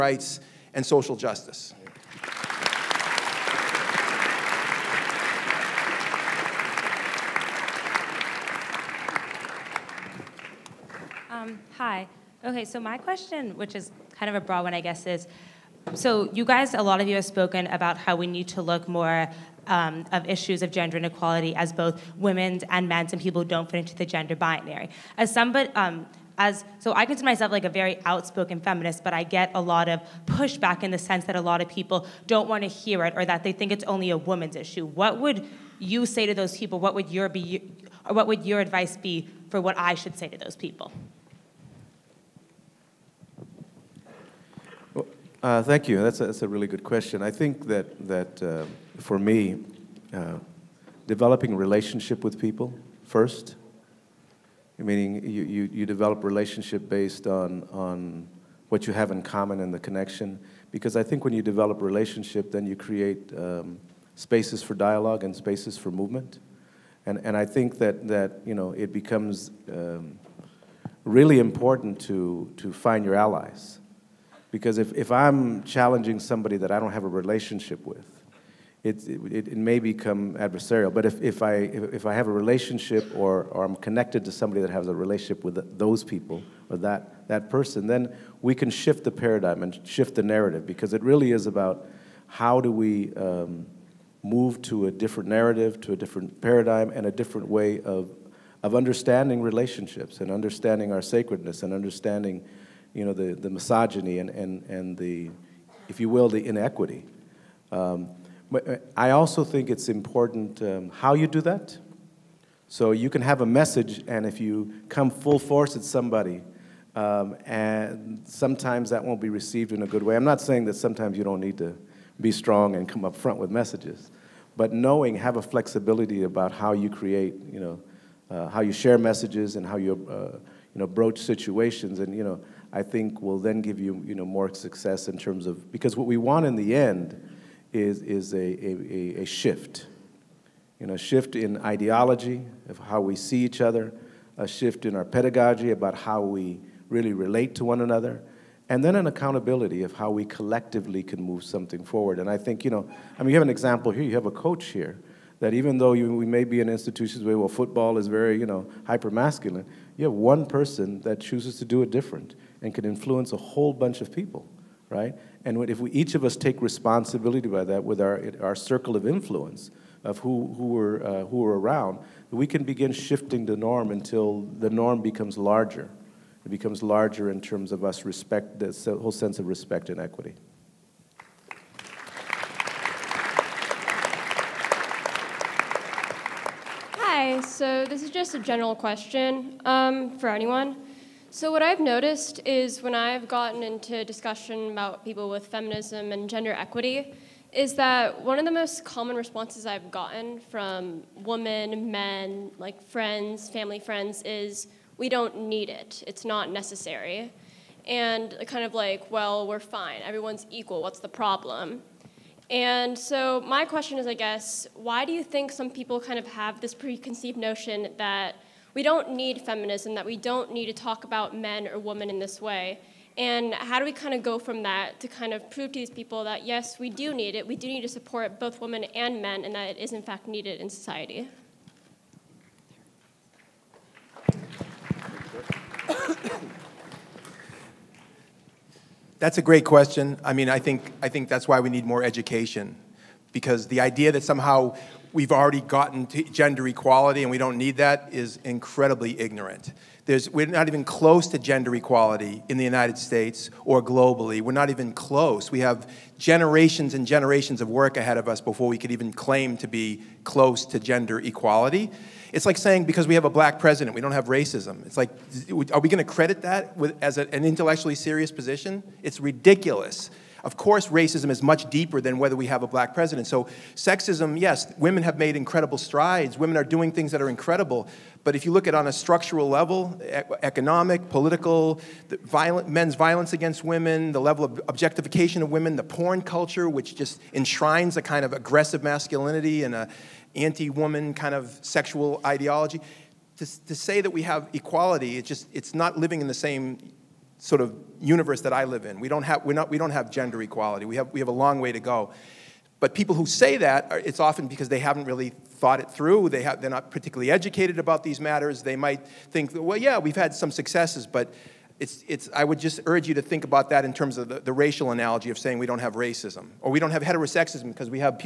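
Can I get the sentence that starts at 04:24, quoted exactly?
It's like, are we going to credit that with, as a, an intellectually serious position?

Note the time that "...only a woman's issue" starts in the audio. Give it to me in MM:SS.
00:33.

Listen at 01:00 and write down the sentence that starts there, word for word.
Because I think when you develop relationship, then you create um, spaces for dialogue and spaces for movement.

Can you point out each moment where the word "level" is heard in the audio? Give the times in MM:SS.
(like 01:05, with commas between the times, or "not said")
04:39, 04:44.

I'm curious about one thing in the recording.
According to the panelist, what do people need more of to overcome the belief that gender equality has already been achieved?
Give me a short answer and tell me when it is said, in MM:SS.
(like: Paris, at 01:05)
Education, at 04:01.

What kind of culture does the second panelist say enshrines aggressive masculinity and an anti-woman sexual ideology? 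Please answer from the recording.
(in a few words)
Porn culture.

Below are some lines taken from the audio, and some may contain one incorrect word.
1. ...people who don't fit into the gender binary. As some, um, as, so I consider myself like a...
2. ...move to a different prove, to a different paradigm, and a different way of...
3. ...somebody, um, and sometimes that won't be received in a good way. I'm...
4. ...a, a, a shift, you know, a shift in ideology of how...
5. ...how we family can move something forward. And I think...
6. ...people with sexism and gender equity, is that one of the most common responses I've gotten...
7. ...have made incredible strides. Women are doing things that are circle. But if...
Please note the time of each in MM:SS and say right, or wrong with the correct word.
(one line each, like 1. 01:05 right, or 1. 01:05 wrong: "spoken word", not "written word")
1. 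00:23 right
2. 01:34 wrong: "narrative", not "prove"
3. 01:55 right
4. 02:18 right
5. 02:29 wrong: "collectively", not "family"
6. 03:15 wrong: "feminism", not "sexism"
7. 04:35 wrong: "incredible", not "circle".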